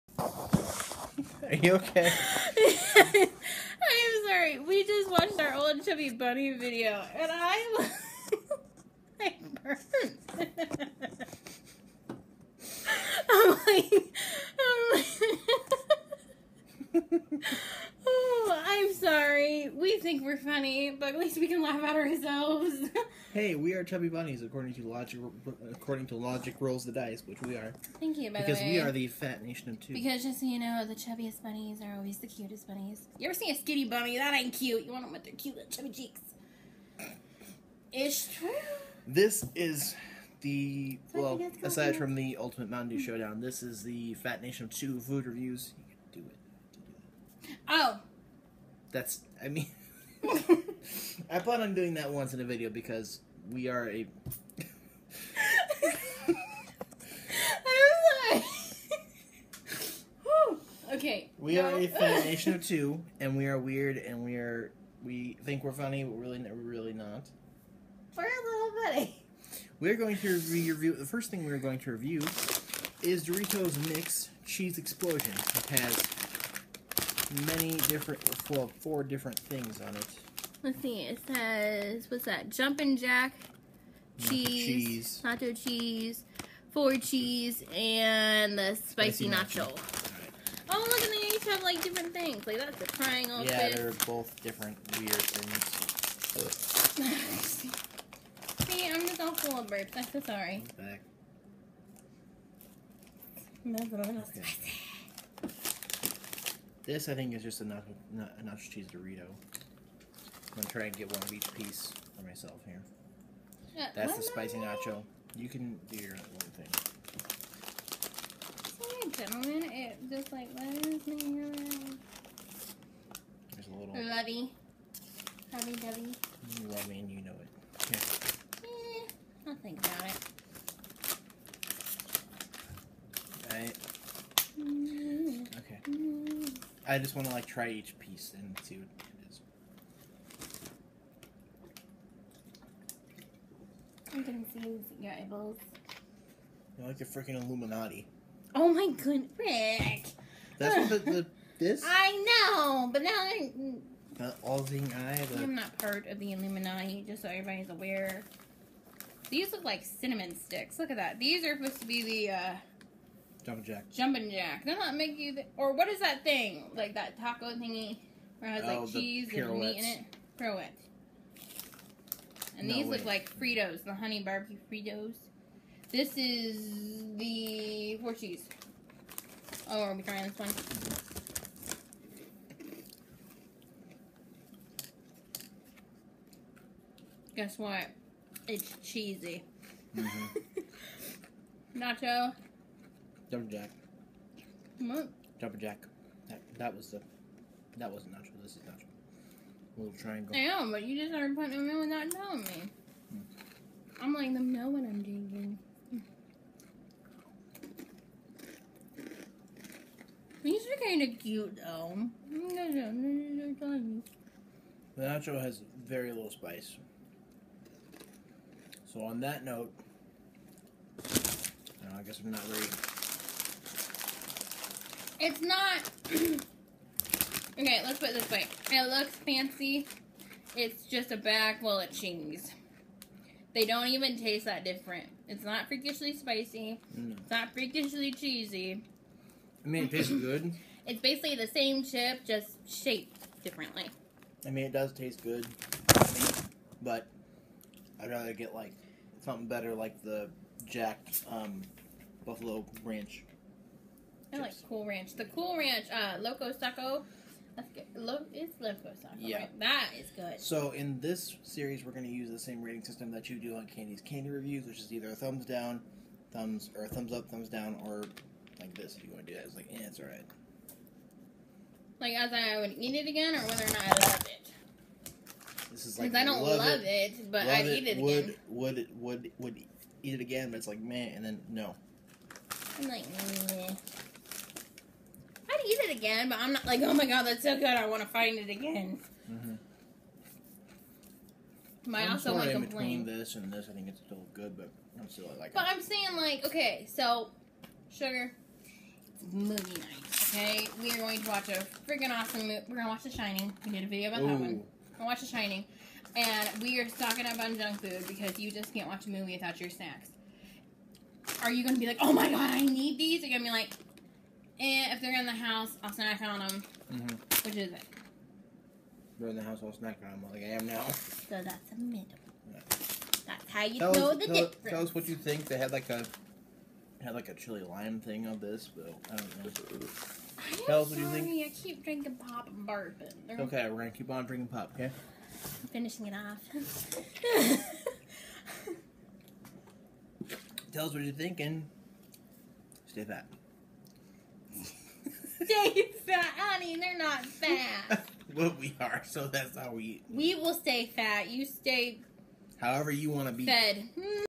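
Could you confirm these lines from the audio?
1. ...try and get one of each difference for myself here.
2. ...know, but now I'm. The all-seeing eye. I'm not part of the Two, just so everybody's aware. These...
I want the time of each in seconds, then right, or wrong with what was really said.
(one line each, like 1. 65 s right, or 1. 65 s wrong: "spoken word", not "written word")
1. 110 s wrong: "piece", not "difference"
2. 152 s wrong: "Illuminati", not "Two".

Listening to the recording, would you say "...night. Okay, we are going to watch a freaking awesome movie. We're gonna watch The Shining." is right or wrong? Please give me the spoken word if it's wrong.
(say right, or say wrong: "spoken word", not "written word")
right.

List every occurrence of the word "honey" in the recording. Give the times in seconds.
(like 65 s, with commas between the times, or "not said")
173 s, 346 s.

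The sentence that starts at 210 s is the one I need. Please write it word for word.
These are kind of cute, though.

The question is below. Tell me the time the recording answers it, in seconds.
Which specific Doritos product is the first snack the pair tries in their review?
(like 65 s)
73 s.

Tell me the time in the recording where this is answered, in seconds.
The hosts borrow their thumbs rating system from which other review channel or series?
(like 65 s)
263 s.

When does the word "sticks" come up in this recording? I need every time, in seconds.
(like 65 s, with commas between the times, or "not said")
160 s.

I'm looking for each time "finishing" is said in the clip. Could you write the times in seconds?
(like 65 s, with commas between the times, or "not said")
335 s.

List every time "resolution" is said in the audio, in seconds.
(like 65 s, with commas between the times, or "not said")
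not said.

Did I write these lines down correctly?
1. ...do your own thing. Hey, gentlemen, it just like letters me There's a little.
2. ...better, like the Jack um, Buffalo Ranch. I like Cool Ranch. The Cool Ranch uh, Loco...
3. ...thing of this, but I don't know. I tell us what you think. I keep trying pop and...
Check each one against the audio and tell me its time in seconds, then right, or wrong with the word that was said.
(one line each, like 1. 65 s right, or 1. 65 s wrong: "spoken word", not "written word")
1. 115 s right
2. 249 s right
3. 327 s wrong: "drinking", not "trying".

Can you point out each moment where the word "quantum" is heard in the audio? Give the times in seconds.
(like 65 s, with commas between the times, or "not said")
not said.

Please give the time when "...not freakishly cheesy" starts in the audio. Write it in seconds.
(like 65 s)
237 s.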